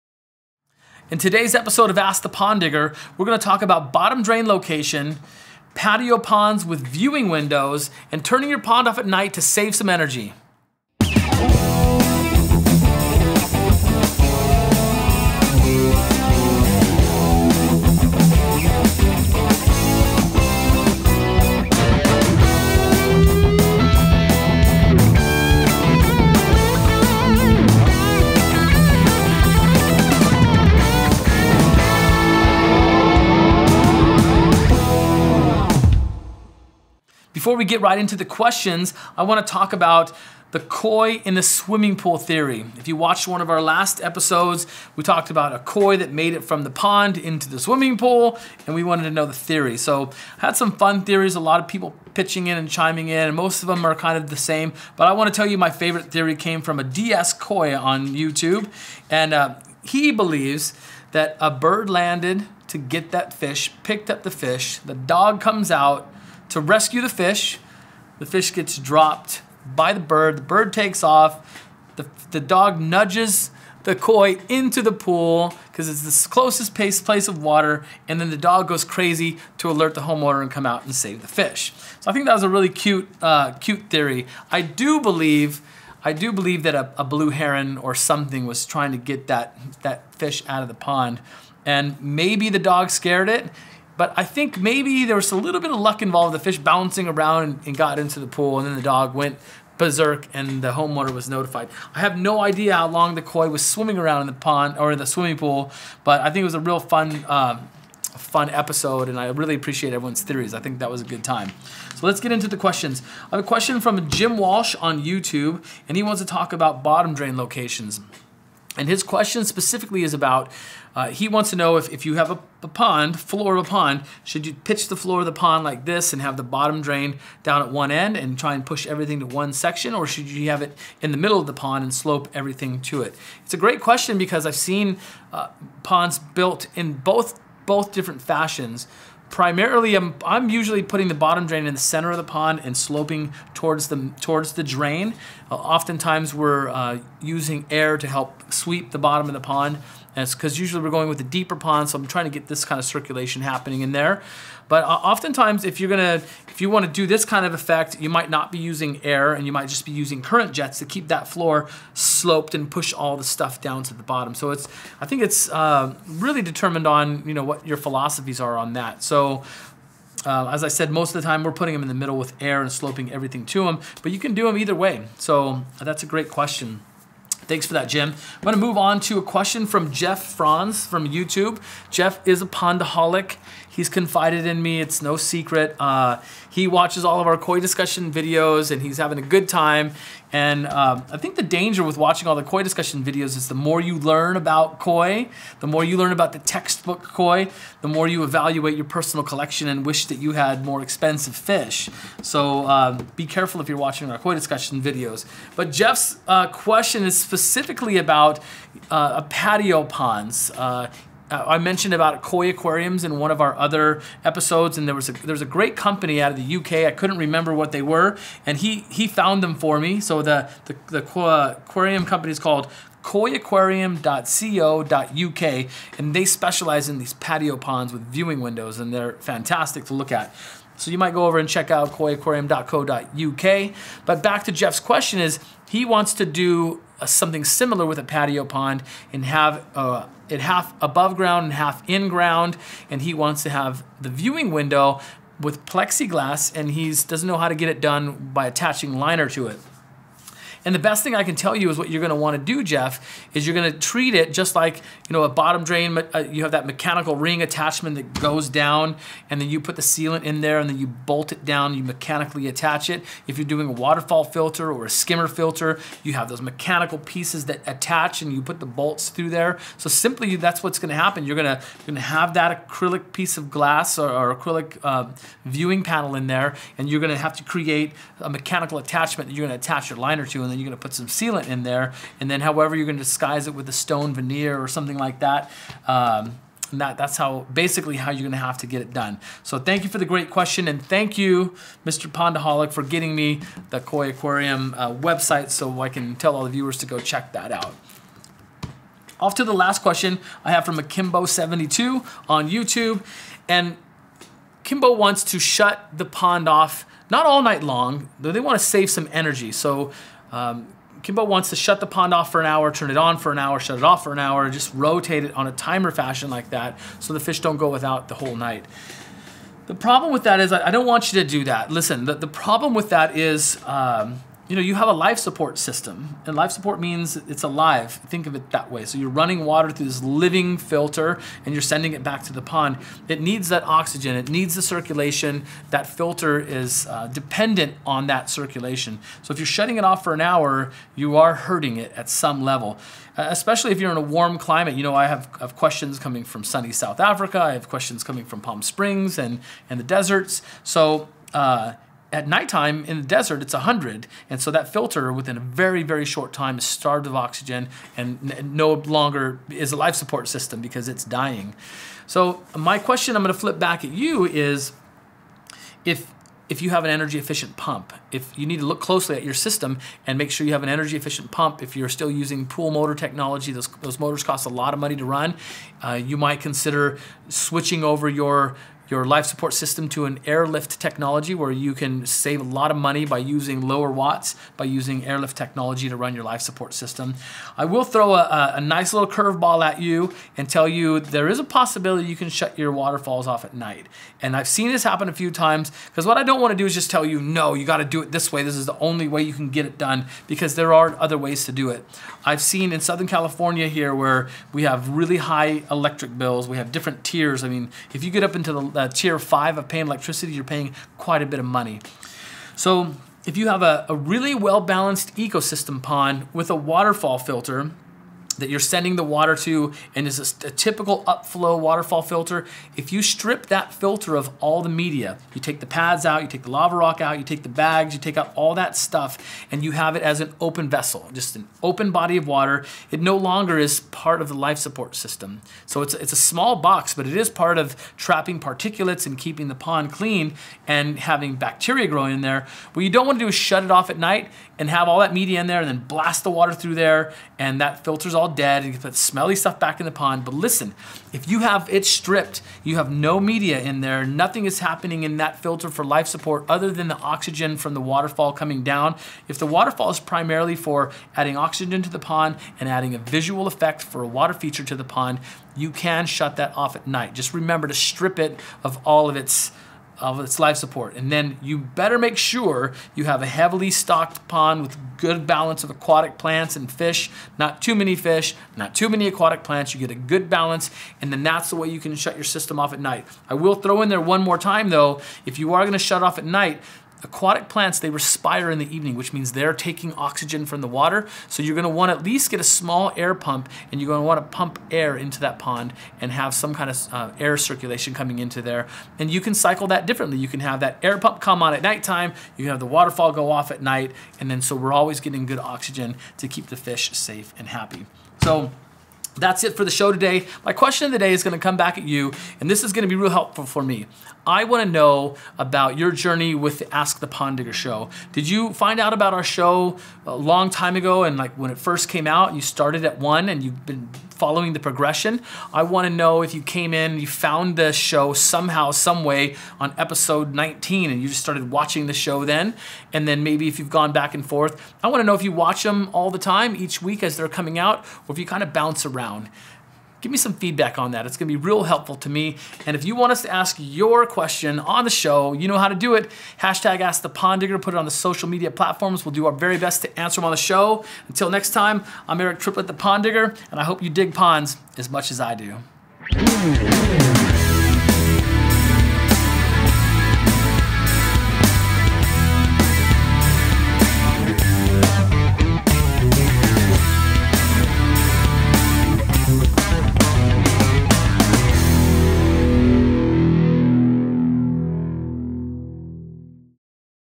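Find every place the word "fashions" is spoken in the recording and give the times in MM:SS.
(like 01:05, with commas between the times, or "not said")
02:18, 05:15.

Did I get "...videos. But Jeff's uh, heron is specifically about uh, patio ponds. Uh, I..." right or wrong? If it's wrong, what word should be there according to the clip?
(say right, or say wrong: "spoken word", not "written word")
wrong: "question", not "heron".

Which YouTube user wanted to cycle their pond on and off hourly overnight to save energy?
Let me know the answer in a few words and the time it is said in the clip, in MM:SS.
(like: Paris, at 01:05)
Akimbo72, at 05:00.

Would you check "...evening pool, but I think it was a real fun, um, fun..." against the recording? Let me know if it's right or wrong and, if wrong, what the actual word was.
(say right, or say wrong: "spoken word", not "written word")
wrong: "swimming", not "evening".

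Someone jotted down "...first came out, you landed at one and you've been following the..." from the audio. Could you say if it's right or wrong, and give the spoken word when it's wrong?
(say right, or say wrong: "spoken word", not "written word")
wrong: "started", not "landed".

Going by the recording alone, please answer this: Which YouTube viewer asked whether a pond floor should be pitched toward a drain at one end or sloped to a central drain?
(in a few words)
Jim Walsh.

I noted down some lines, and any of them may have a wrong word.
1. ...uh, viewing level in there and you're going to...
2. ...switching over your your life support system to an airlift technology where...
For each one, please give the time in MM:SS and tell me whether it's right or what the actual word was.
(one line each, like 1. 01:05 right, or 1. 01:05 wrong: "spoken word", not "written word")
1. 04:34 wrong: "panel", not "level"
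2. 06:17 right.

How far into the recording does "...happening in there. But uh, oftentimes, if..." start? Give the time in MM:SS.
02:33.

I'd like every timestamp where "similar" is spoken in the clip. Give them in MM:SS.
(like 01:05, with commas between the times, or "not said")
03:57.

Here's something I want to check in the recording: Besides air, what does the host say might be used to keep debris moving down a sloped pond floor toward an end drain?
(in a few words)
Current jets.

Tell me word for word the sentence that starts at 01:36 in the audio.
The fish bouncing around and, and got into the pool, and then the dog went berserk and the homeowner was notified.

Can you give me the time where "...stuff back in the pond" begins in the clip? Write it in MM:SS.
07:29.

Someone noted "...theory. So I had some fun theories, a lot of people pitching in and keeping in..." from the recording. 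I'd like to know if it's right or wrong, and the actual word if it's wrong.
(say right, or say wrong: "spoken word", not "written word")
wrong: "chiming", not "keeping".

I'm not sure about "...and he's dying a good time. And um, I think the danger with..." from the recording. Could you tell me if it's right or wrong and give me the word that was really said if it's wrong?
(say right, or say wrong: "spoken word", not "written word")
wrong: "having", not "dying".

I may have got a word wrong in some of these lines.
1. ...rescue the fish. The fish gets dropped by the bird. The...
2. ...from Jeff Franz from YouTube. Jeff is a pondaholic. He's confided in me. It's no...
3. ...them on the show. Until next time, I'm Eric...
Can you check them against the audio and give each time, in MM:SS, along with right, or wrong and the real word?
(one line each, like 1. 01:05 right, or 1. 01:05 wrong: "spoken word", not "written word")
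1. 01:06 right
2. 02:59 right
3. 09:10 right.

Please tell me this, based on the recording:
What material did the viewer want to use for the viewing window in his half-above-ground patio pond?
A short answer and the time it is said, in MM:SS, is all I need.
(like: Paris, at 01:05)
Plexiglass, at 04:05.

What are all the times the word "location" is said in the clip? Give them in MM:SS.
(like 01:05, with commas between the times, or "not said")
00:04, 01:57.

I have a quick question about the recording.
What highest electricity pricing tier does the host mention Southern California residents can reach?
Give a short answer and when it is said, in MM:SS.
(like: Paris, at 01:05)
Tier 5, at 06:48.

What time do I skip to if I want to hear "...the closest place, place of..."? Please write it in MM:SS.
01:16.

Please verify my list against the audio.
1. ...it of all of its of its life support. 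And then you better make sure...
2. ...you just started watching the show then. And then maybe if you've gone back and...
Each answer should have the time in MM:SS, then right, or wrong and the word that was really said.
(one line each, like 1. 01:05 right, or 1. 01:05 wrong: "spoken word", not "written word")
1. 07:48 right
2. 08:51 right.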